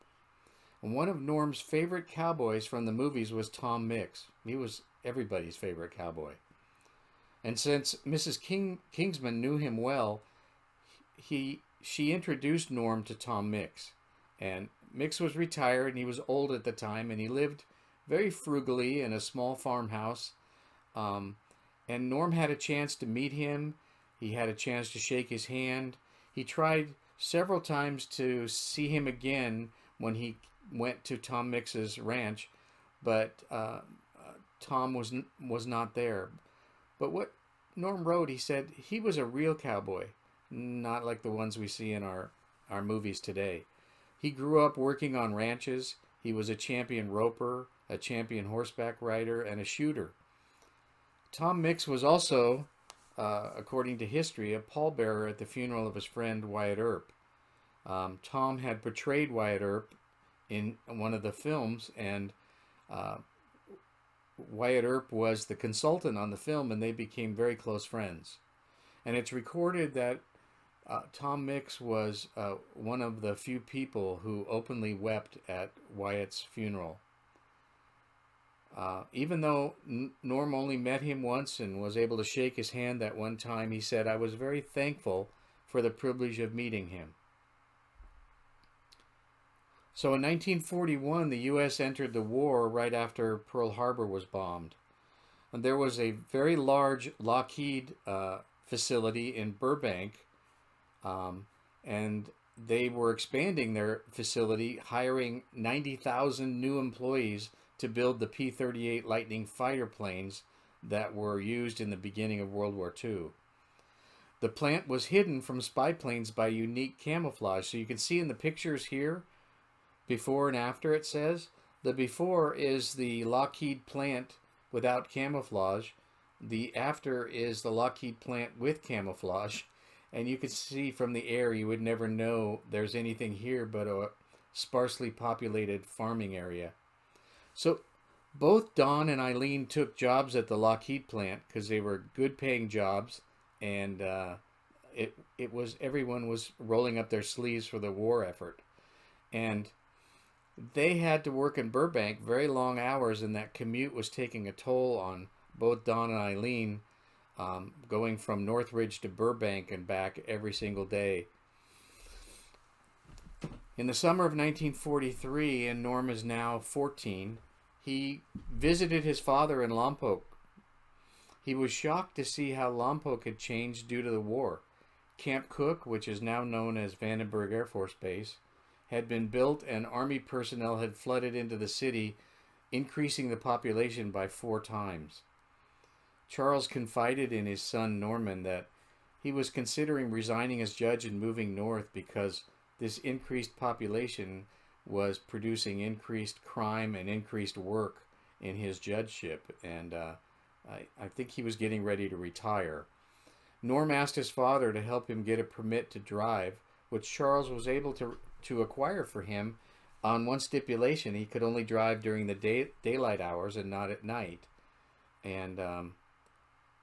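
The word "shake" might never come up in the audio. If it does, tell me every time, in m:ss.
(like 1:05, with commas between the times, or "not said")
0:24, 1:22.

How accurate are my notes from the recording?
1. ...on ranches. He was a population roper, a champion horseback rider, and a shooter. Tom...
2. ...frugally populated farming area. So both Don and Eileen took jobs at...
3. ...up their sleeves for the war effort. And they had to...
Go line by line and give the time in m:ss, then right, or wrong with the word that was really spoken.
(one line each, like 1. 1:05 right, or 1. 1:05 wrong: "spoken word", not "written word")
1. 0:45 wrong: "champion", not "population"
2. 2:14 wrong: "sparsely", not "frugally"
3. 2:26 right.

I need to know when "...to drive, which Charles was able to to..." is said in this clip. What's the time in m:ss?
3:25.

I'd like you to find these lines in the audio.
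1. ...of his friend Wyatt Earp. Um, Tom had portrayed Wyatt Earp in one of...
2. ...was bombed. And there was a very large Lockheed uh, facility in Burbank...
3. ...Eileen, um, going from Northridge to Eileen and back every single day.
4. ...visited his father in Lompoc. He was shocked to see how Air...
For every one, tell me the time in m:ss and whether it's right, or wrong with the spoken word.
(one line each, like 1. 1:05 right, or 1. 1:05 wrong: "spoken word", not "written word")
1. 0:55 right
2. 1:34 right
3. 2:36 wrong: "Burbank", not "Eileen"
4. 2:48 wrong: "Lompoc", not "Air".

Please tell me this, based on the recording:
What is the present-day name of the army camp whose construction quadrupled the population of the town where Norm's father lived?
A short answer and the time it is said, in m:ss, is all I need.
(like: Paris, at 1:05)
Vandenberg Air Force Base, at 2:56.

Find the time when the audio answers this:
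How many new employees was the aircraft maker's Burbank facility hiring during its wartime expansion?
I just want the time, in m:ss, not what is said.
1:45.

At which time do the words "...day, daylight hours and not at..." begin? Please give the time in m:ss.
3:32.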